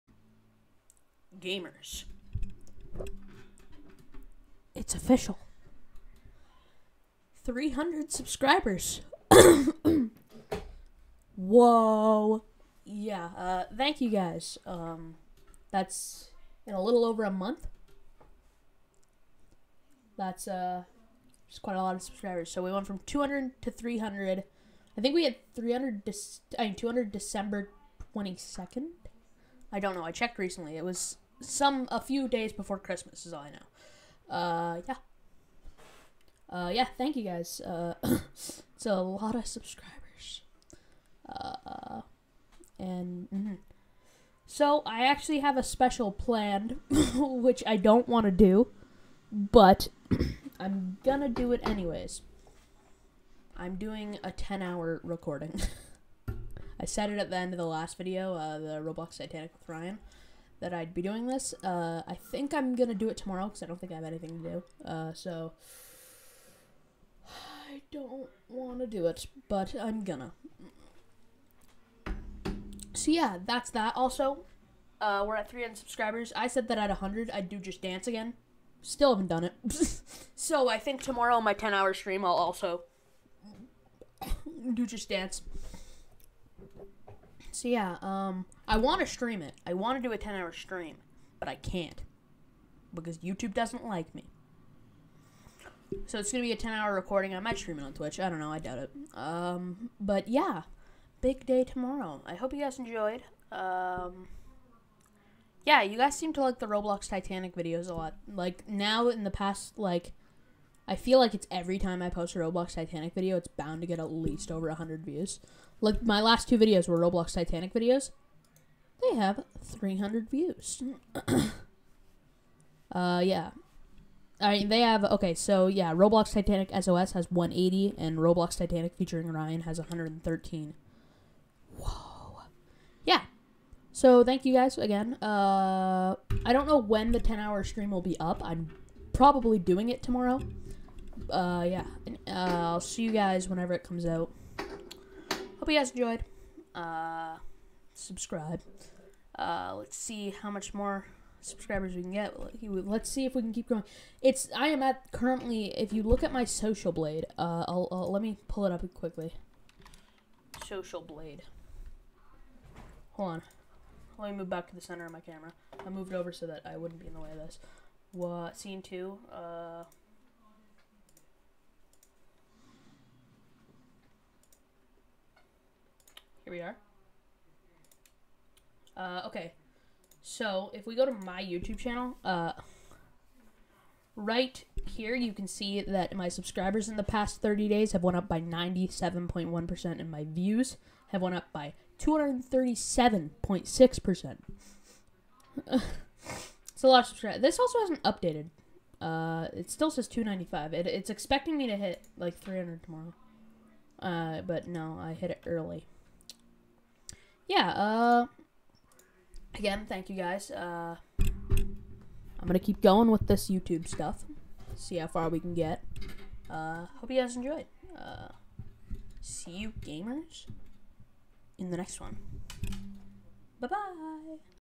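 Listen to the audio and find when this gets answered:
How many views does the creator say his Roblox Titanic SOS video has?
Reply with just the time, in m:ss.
2:07.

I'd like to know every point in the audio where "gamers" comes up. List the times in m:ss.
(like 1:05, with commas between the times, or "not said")
0:01, 3:39.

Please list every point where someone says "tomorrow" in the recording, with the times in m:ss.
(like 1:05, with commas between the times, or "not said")
1:03, 1:21, 1:41, 2:20, 3:22.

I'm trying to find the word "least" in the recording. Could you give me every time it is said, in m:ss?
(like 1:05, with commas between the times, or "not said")
1:54.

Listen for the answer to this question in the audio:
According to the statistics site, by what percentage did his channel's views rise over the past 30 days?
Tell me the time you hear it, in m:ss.
3:11.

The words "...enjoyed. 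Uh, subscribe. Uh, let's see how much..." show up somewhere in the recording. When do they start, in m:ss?
2:25.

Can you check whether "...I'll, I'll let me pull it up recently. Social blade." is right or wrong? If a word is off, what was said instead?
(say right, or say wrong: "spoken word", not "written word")
wrong: "quickly", not "recently".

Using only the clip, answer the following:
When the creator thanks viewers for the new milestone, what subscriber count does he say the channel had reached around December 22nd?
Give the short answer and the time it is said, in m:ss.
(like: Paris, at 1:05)
200, at 0:26.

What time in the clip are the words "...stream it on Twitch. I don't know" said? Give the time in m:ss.
1:37.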